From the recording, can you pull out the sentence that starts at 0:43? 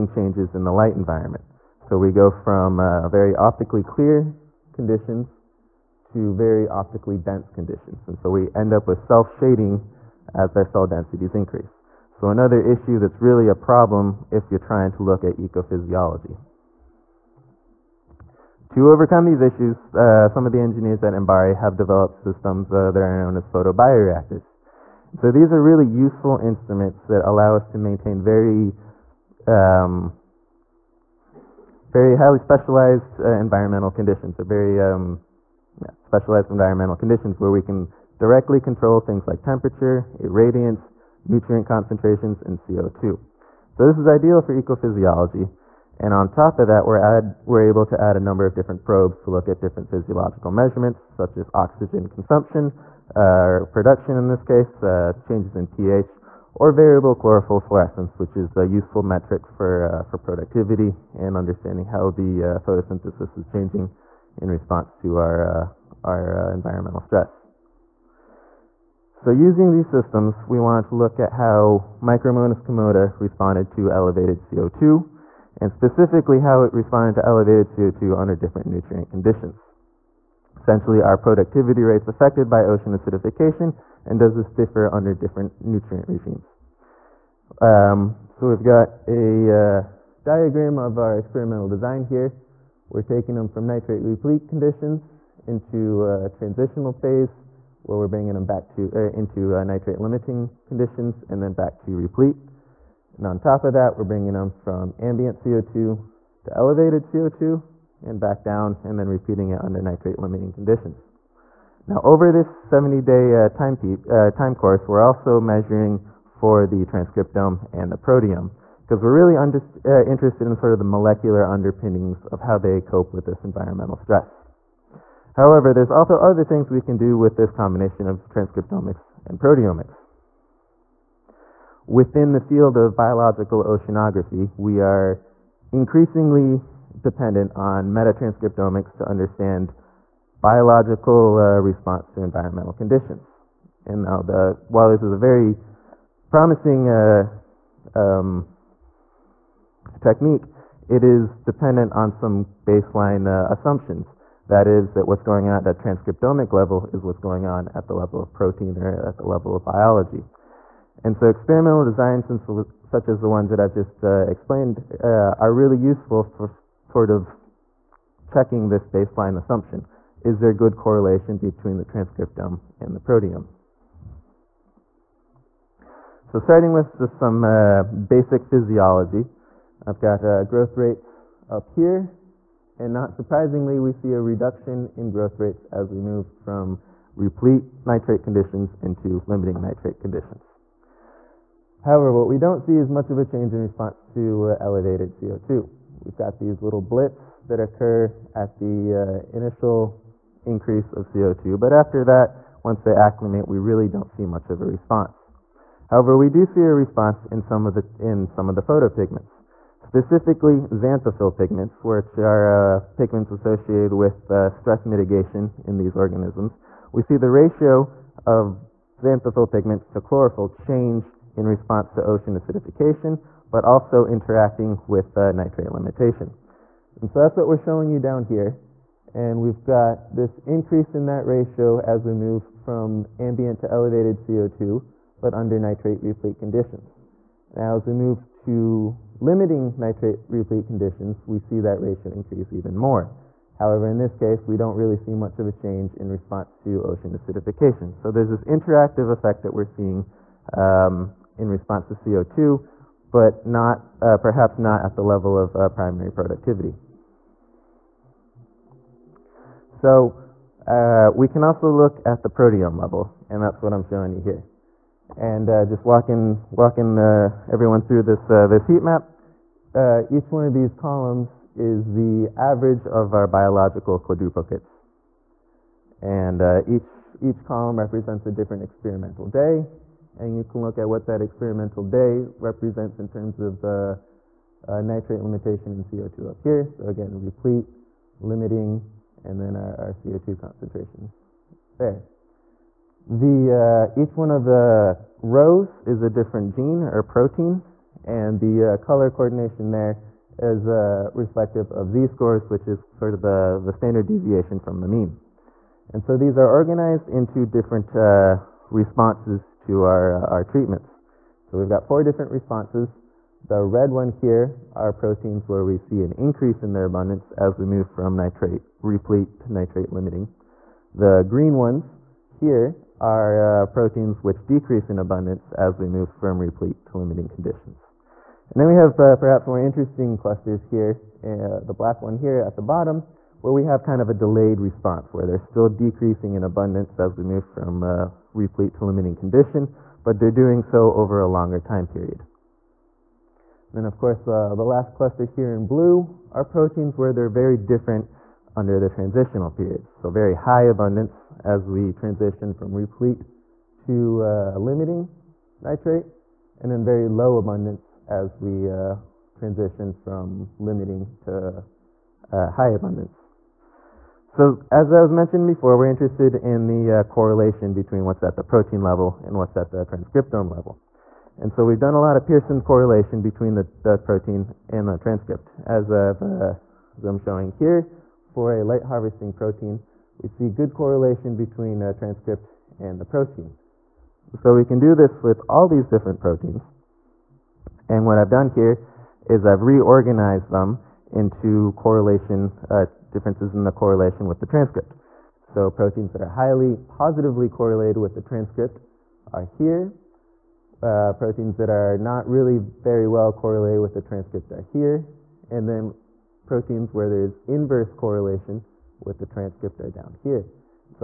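So this is ideal for ecophysiology.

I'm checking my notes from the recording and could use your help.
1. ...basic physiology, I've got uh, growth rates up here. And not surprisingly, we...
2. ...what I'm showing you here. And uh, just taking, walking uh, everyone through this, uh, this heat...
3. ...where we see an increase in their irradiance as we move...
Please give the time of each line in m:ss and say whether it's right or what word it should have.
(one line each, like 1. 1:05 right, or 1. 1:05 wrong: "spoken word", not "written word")
1. 2:57 right
2. 4:23 wrong: "walking", not "taking"
3. 5:15 wrong: "abundance", not "irradiance".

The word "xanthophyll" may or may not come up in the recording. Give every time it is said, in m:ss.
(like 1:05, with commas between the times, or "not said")
3:30, 3:38.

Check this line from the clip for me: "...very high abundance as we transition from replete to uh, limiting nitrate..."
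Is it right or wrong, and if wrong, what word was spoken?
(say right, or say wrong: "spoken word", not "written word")
right.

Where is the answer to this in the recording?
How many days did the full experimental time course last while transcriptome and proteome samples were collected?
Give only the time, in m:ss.
1:52.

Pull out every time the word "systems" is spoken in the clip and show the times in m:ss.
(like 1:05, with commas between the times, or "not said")
0:22, 1:09.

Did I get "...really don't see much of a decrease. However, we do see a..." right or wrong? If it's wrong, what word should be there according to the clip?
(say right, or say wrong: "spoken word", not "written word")
wrong: "response", not "decrease".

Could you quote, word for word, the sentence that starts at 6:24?
So, we can do this with all these different proteins.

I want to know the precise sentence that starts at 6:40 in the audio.
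Uh, proteins that are not really very well correlated with the transcript are here.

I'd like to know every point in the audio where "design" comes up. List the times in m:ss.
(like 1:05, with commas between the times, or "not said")
1:31, 2:41.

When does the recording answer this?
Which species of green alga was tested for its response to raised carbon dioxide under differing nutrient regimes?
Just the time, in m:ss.
1:12.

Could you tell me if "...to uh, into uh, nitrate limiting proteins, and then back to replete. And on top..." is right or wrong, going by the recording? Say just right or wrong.
wrong.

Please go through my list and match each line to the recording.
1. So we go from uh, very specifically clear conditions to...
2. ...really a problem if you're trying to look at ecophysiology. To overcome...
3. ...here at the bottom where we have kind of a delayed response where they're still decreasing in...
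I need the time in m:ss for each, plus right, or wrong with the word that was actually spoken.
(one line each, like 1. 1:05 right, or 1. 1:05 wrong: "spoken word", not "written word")
1. 0:01 wrong: "optically", not "specifically"
2. 0:13 right
3. 5:32 right.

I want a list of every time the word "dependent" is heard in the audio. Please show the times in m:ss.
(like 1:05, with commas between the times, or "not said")
2:17, 2:31.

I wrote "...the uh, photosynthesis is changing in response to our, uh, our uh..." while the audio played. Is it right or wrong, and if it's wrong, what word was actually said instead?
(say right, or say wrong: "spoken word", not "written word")
right.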